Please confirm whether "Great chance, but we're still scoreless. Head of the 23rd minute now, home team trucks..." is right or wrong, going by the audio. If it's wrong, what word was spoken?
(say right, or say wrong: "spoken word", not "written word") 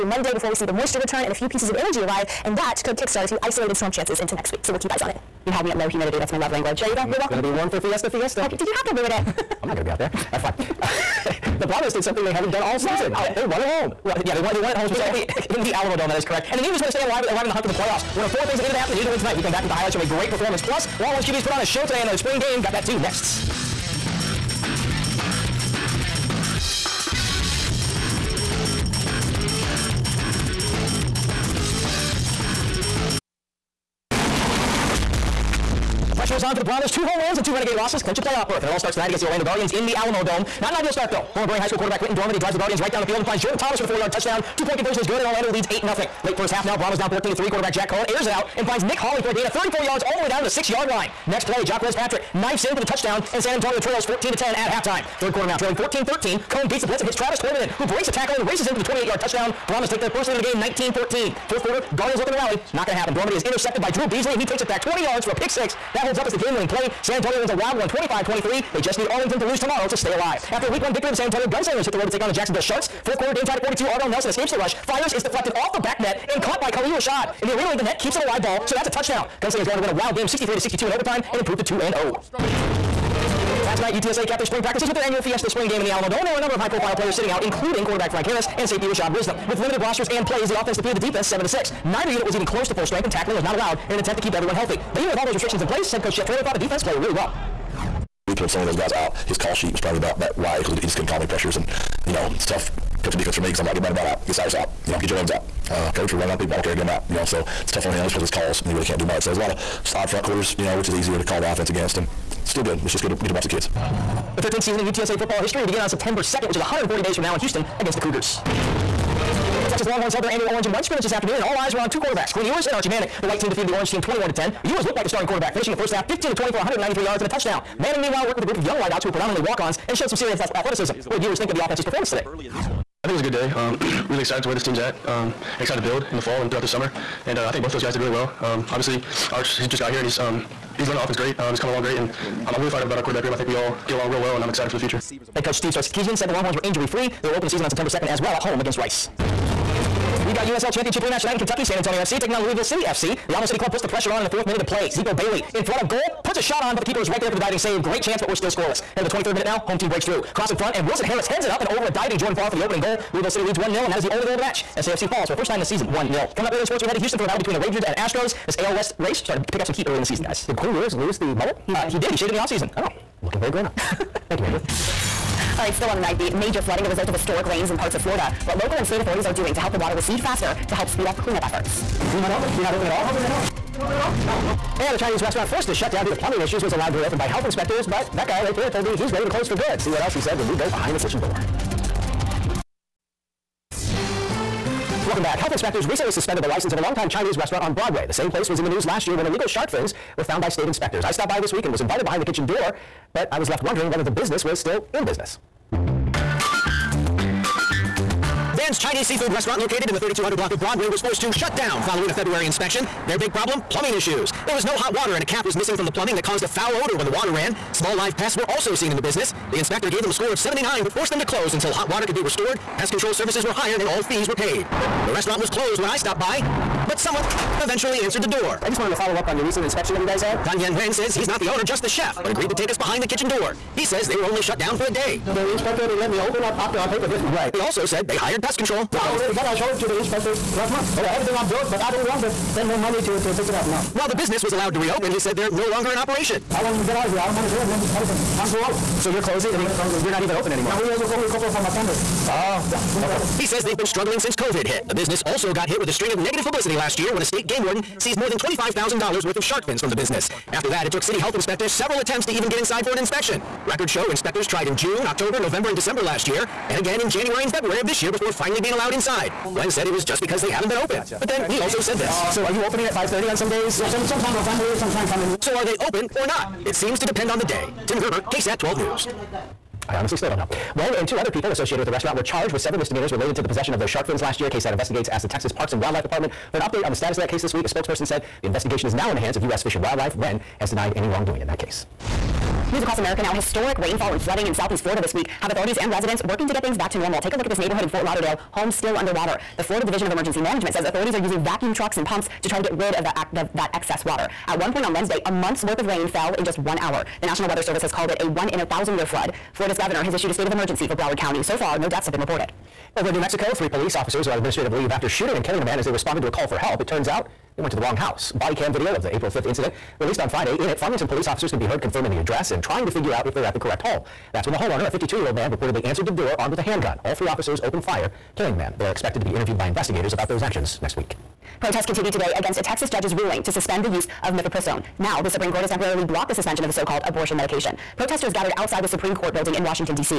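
wrong: "breaks", not "trucks".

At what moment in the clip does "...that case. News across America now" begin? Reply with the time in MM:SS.
04:51.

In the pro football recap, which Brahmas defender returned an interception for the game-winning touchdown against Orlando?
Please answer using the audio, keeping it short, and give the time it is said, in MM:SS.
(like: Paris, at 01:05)
Drew Beasley, at 01:03.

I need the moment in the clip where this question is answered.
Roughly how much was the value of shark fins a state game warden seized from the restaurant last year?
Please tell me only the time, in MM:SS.
04:18.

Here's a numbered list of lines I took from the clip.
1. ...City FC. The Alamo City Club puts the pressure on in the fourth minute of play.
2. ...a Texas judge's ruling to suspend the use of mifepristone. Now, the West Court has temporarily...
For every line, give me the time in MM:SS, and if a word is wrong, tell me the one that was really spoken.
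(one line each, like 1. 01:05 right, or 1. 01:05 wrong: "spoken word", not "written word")
1. 02:32 right
2. 05:32 wrong: "Supreme", not "West".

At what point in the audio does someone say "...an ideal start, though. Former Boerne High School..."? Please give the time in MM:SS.
00:40.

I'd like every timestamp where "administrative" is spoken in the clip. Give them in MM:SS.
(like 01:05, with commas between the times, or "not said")
05:14.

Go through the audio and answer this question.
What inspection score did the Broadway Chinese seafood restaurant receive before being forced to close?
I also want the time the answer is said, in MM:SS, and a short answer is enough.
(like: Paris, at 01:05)
79, at 03:40.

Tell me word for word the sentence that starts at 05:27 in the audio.
All three officers opened fire killing the man.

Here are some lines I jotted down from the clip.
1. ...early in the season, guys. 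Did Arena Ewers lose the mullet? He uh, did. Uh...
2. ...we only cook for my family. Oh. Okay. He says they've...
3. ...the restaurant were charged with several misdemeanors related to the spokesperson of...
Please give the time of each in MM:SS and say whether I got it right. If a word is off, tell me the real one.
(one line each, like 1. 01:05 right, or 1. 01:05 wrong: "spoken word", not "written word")
1. 02:49 wrong: "Quinn", not "Arena"
2. 04:10 right
3. 04:41 wrong: "possession", not "spokesperson".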